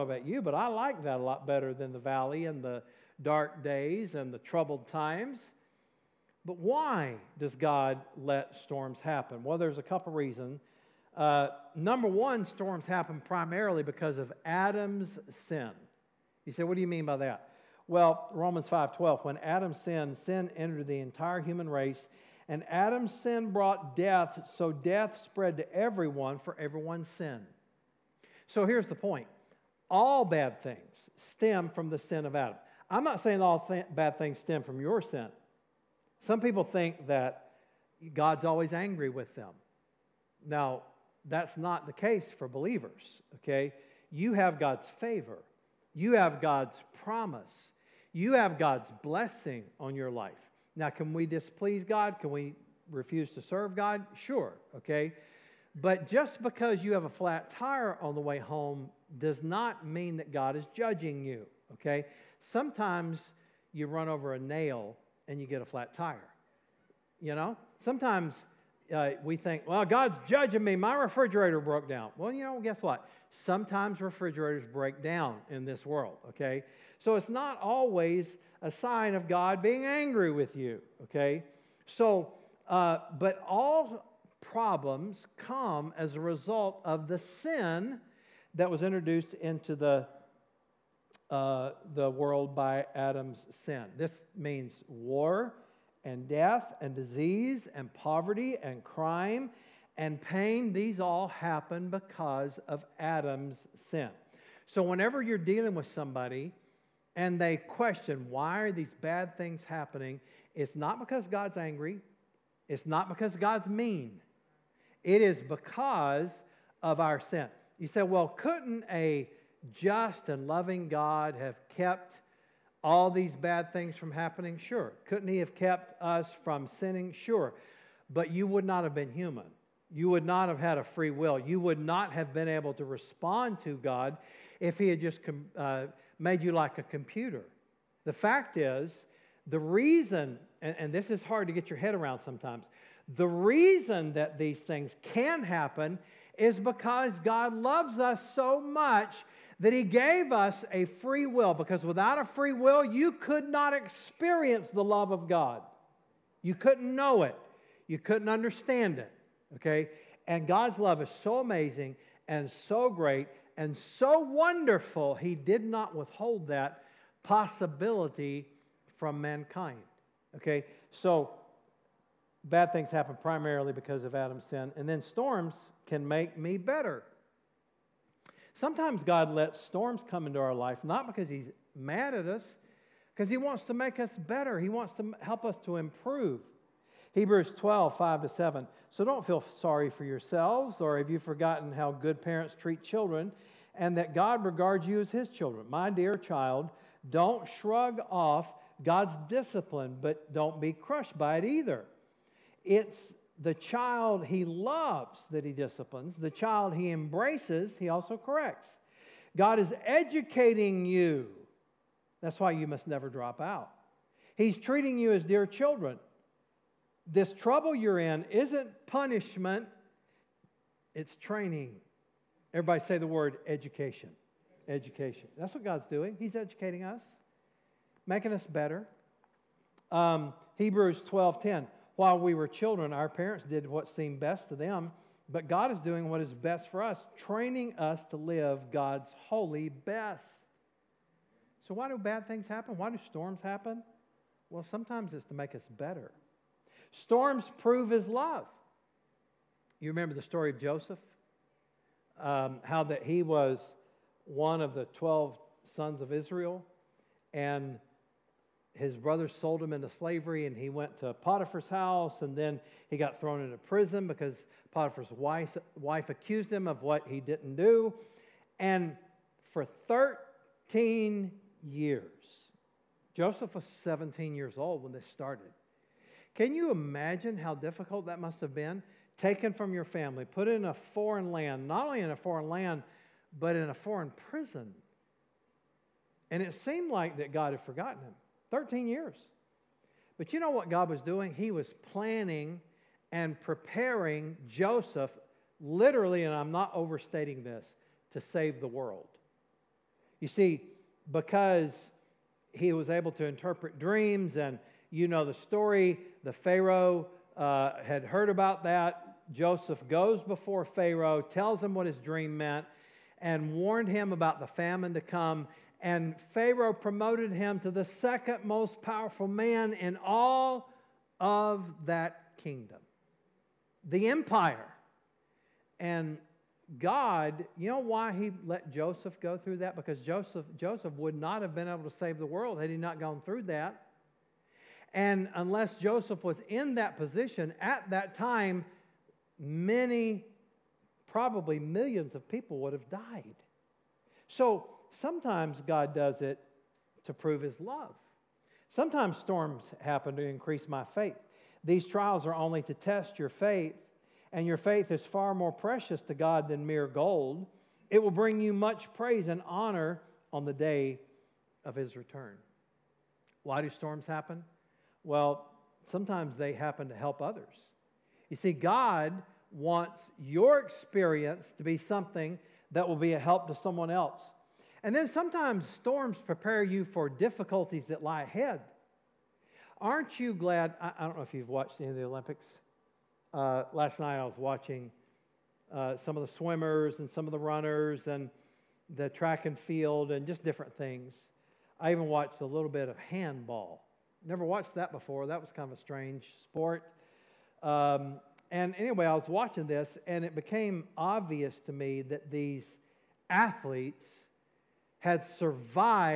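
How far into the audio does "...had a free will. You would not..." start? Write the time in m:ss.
2:10.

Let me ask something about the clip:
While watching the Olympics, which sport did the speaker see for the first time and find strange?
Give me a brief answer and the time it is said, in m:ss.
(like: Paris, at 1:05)
Handball, at 6:32.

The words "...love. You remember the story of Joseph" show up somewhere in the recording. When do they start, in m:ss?
4:08.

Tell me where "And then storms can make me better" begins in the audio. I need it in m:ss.
2:54.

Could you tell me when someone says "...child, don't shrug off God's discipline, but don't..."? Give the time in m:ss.
3:16.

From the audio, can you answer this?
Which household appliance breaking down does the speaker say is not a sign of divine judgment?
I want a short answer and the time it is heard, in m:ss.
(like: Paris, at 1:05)
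Refrigerator, at 1:10.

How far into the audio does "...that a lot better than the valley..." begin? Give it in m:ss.
0:01.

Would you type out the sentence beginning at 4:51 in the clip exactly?
He was planning and preparing Joseph, literally, and I'm not overstating this, to save the world.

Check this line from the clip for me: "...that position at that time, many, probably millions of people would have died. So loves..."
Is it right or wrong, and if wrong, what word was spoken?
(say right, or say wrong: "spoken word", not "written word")
wrong: "sometimes", not "loves".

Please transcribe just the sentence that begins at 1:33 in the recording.
This means war and death and disease and poverty and crime and pain.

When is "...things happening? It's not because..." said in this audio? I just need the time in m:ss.
1:49.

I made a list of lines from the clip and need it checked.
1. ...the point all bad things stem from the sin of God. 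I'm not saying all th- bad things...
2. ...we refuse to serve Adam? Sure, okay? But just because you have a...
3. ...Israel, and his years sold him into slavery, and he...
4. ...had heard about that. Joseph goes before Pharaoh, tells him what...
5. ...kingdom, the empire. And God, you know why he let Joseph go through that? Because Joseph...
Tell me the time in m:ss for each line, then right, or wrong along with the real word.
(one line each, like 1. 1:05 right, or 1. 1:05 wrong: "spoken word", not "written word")
1. 0:28 wrong: "Adam", not "God"
2. 0:52 wrong: "God", not "Adam"
3. 4:16 wrong: "brothers", not "years"
4. 5:07 right
5. 5:22 right.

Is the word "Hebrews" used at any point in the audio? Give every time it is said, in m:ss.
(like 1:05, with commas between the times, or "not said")
3:07, 3:50.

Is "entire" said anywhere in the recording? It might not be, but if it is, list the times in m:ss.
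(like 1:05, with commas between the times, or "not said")
0:20.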